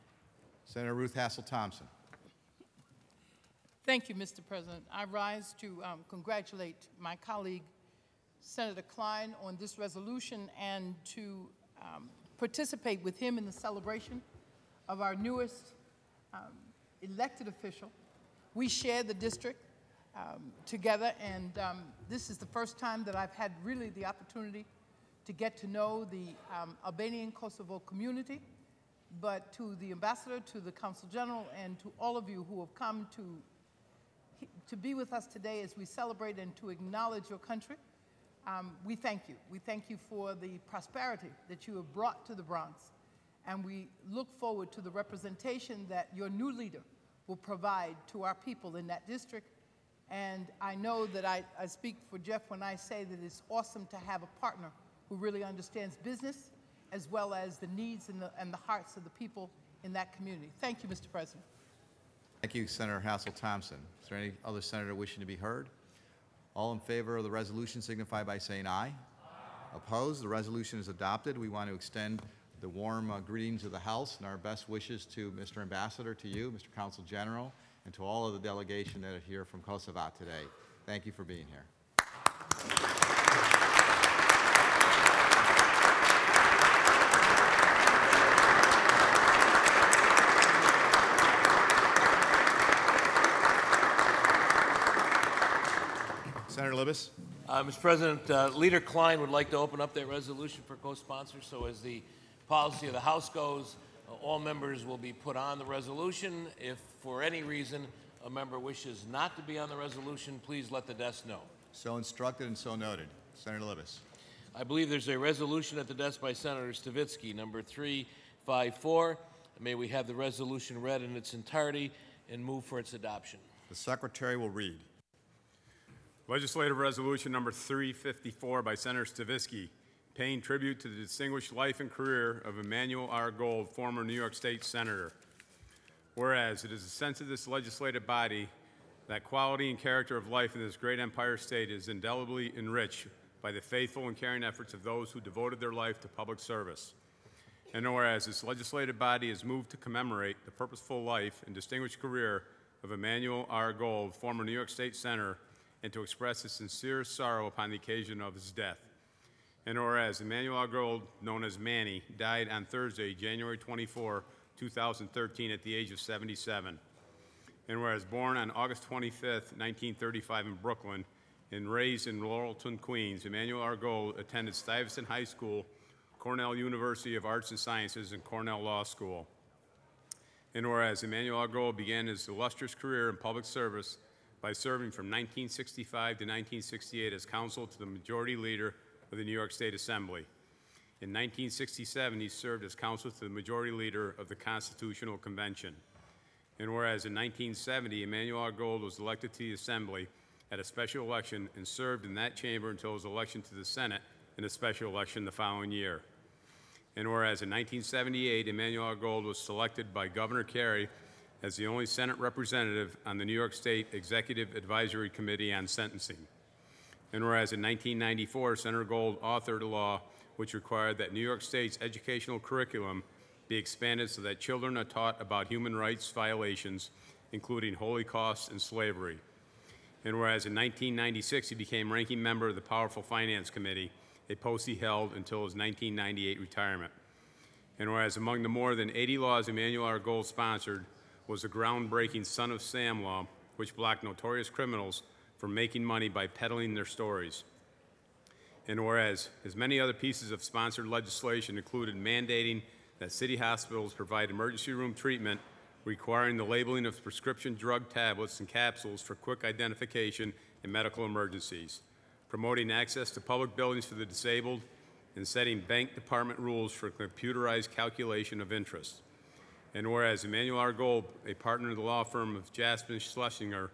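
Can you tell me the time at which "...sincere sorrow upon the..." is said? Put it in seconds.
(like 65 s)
156 s.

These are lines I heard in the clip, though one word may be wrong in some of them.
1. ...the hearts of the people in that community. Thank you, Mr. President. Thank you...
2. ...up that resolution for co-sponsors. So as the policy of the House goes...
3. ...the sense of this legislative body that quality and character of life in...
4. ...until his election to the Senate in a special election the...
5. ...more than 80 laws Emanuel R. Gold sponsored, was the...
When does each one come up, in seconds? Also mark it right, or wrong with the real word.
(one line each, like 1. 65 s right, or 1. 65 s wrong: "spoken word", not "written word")
1. 58 s right
2. 99 s right
3. 136 s right
4. 202 s right
5. 238 s right.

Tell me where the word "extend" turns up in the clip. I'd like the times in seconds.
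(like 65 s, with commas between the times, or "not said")
71 s.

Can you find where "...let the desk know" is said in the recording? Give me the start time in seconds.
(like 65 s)
110 s.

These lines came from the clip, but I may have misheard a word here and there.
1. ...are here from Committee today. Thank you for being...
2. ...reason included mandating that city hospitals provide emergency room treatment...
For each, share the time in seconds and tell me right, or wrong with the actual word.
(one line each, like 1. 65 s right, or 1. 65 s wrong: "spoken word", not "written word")
1. 79 s wrong: "Kosovo", not "Committee"
2. 250 s wrong: "legislation", not "reason".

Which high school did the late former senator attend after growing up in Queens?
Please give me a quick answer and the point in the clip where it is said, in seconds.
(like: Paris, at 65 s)
Stuyvesant High School, at 174 s.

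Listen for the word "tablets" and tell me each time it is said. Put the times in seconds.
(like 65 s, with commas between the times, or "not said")
257 s.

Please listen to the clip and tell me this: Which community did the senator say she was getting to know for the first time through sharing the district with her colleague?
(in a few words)
Albanian Kosovo community.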